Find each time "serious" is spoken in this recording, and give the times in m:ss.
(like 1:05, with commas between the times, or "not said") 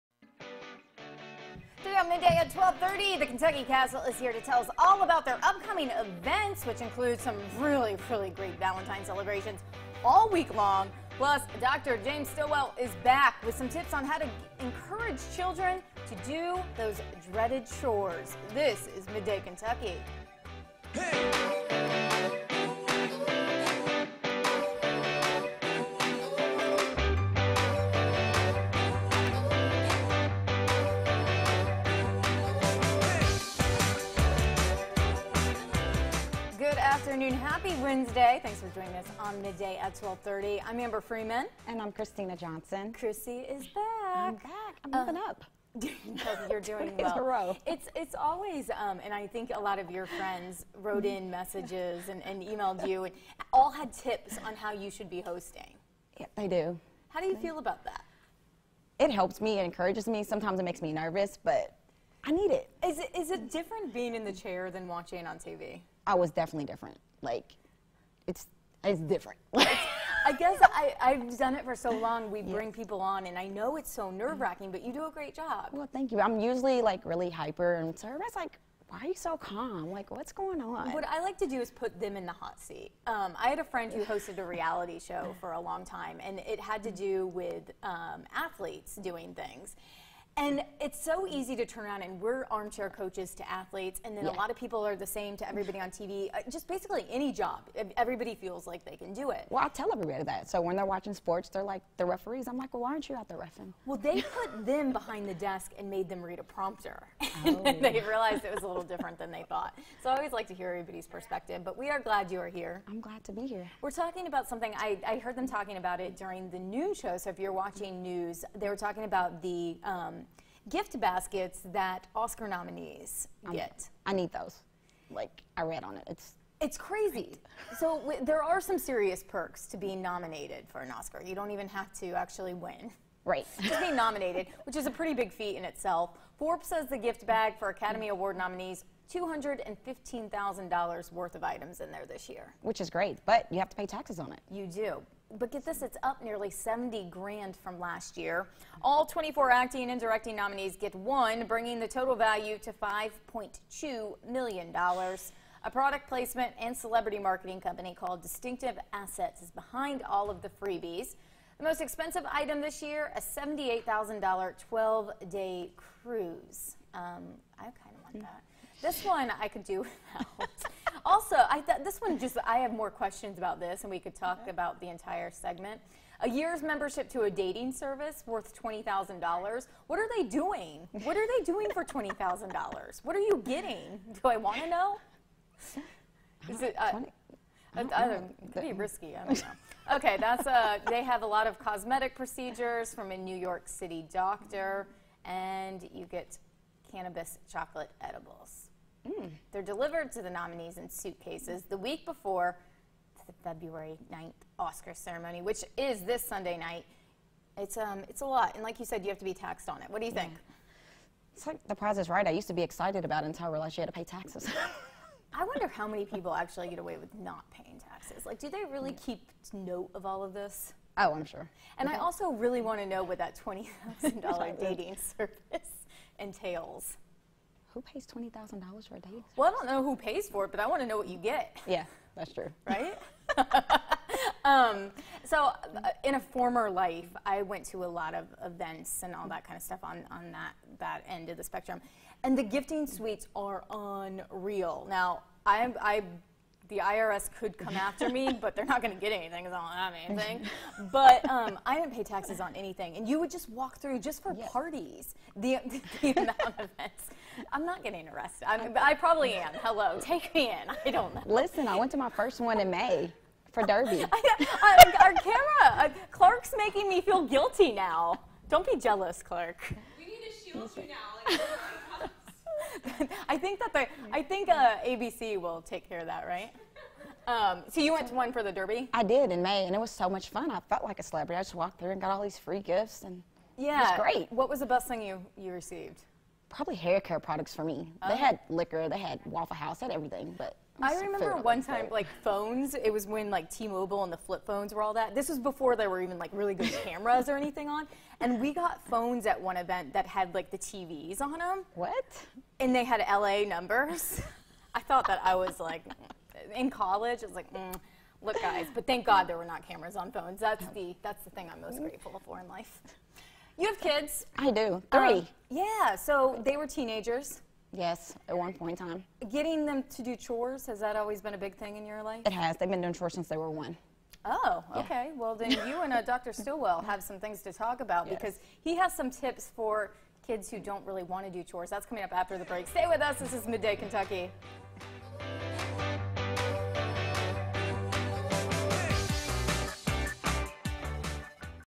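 2:08.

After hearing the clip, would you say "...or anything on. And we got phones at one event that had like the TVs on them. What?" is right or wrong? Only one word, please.
right.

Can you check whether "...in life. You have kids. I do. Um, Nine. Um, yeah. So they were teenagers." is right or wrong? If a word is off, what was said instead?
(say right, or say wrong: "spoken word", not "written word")
wrong: "Three", not "Nine".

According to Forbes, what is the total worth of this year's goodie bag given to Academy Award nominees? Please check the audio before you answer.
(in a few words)
$215,000.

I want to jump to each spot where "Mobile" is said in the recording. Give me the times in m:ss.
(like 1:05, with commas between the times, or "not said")
4:53.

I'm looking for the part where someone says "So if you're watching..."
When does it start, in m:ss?
1:57.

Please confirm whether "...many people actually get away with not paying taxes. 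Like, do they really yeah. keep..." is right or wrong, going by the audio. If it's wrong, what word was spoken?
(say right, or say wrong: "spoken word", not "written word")
right.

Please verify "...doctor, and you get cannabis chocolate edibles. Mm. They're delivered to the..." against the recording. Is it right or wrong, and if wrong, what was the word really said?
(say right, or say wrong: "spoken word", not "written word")
right.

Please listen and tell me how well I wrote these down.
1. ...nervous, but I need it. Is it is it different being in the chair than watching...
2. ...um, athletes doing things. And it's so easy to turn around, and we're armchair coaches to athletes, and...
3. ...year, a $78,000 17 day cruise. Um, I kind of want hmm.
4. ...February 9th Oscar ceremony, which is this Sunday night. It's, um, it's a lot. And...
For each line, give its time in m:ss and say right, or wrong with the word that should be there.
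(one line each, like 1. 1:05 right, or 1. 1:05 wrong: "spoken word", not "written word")
1. 1:00 right
2. 1:27 right
3. 2:42 wrong: "12", not "17"
4. 3:23 right.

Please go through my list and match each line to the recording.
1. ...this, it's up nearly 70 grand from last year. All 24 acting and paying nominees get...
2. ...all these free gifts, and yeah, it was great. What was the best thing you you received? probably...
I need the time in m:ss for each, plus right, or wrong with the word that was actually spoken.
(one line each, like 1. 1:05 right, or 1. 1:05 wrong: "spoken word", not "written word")
1. 2:25 wrong: "directing", not "paying"
2. 4:42 right.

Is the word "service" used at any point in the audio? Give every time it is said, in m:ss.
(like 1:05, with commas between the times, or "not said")
2:57, 3:45, 3:49.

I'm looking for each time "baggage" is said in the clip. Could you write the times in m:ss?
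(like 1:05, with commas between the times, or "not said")
not said.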